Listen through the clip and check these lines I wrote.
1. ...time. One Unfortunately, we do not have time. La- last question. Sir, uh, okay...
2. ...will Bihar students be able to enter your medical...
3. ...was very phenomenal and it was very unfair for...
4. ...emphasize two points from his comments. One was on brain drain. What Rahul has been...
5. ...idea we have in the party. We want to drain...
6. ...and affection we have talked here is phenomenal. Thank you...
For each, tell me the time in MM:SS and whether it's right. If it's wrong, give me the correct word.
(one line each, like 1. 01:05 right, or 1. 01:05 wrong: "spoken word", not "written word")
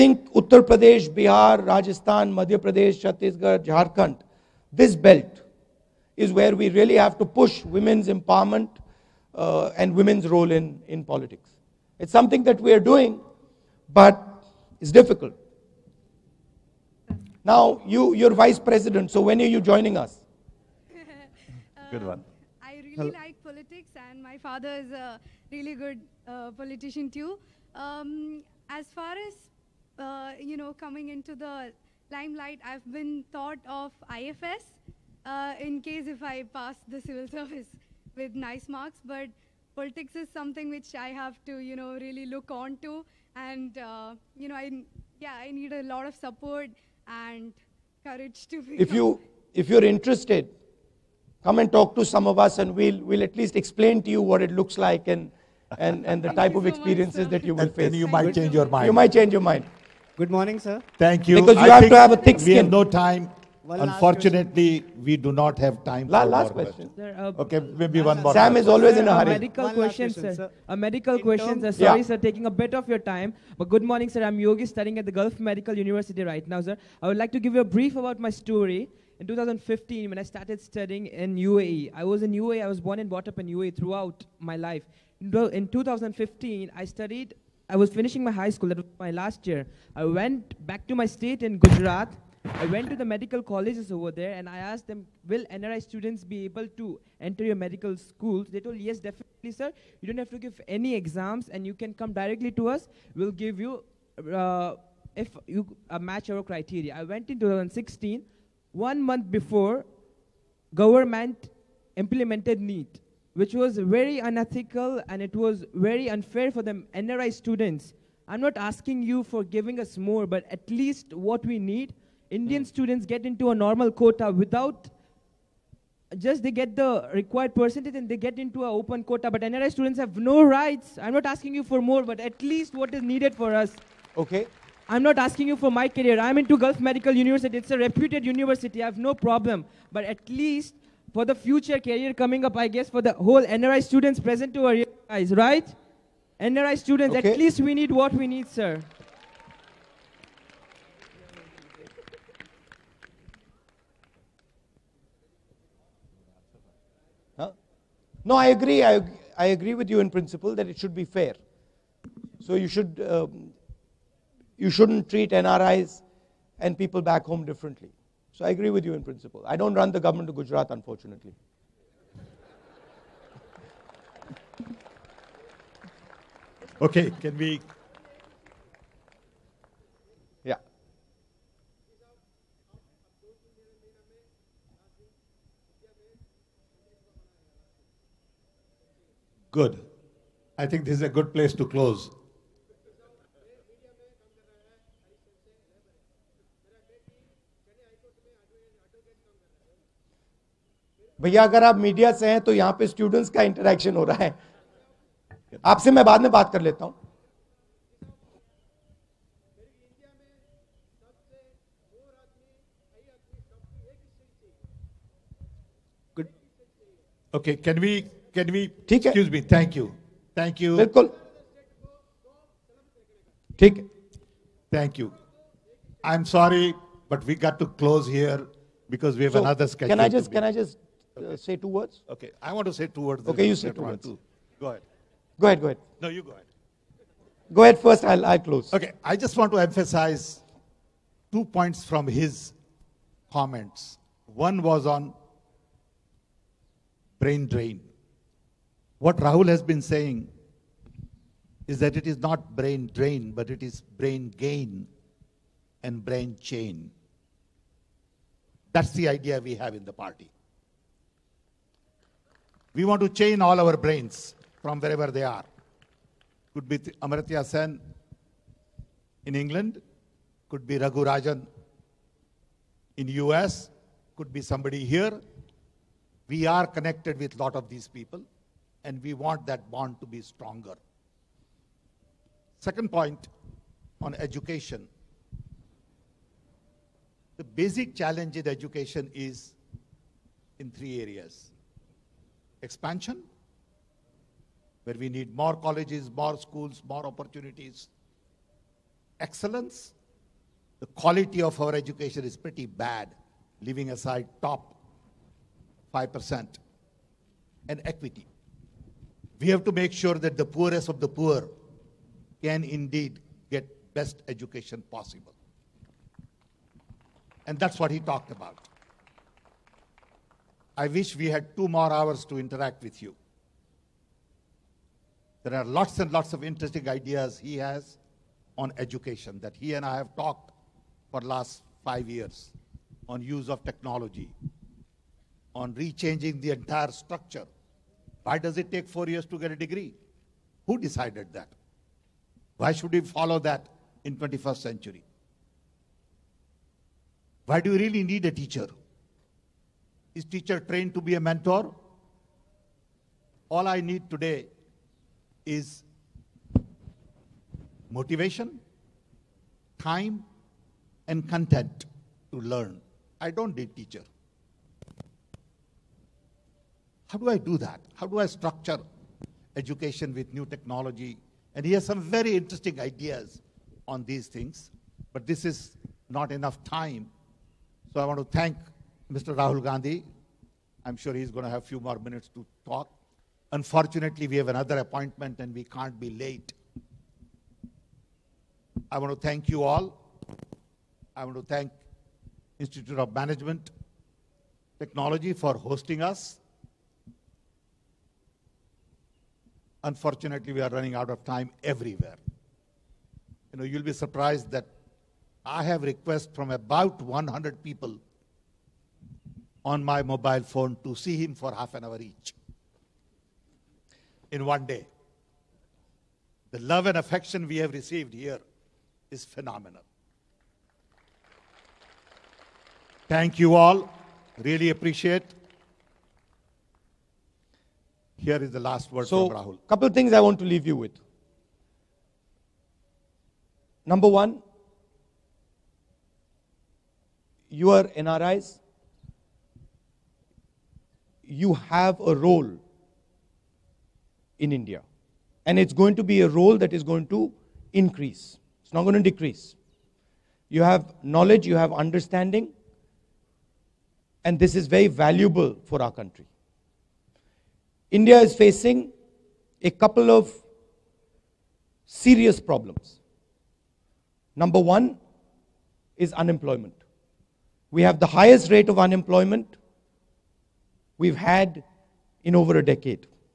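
1. 01:02 right
2. 01:35 wrong: "NRI", not "Bihar"
3. 01:53 wrong: "unethical", not "phenomenal"
4. 03:59 right
5. 04:19 wrong: "chain", not "drain"
6. 06:56 wrong: "received", not "talked".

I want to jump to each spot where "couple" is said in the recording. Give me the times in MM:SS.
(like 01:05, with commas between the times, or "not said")
07:09, 07:39.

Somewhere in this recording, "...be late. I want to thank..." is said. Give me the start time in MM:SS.
06:25.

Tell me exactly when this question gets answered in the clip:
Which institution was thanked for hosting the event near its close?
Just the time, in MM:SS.
06:32.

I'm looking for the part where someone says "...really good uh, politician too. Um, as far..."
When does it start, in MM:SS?
00:25.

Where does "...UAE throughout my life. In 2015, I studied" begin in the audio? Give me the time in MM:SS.
01:23.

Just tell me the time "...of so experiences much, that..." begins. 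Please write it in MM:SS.
00:56.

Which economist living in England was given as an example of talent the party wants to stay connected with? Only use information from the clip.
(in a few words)
Amartya Sen.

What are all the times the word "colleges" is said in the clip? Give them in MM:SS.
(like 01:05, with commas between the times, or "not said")
01:33, 04:55.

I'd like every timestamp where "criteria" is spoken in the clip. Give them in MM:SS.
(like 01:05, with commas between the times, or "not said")
01:46.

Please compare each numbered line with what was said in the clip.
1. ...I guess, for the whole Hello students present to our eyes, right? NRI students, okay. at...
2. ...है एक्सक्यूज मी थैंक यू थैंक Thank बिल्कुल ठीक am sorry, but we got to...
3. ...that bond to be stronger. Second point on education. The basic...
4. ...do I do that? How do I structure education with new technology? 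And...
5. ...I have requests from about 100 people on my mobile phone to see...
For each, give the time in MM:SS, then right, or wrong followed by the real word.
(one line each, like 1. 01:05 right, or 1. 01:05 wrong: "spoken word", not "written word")
1. 02:22 wrong: "NRI", not "Hello"
2. 03:39 right
3. 04:39 right
4. 06:07 right
5. 06:45 right.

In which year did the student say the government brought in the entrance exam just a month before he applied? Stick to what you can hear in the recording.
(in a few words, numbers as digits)
2016.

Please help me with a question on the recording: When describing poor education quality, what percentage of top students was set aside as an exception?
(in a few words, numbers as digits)
5%.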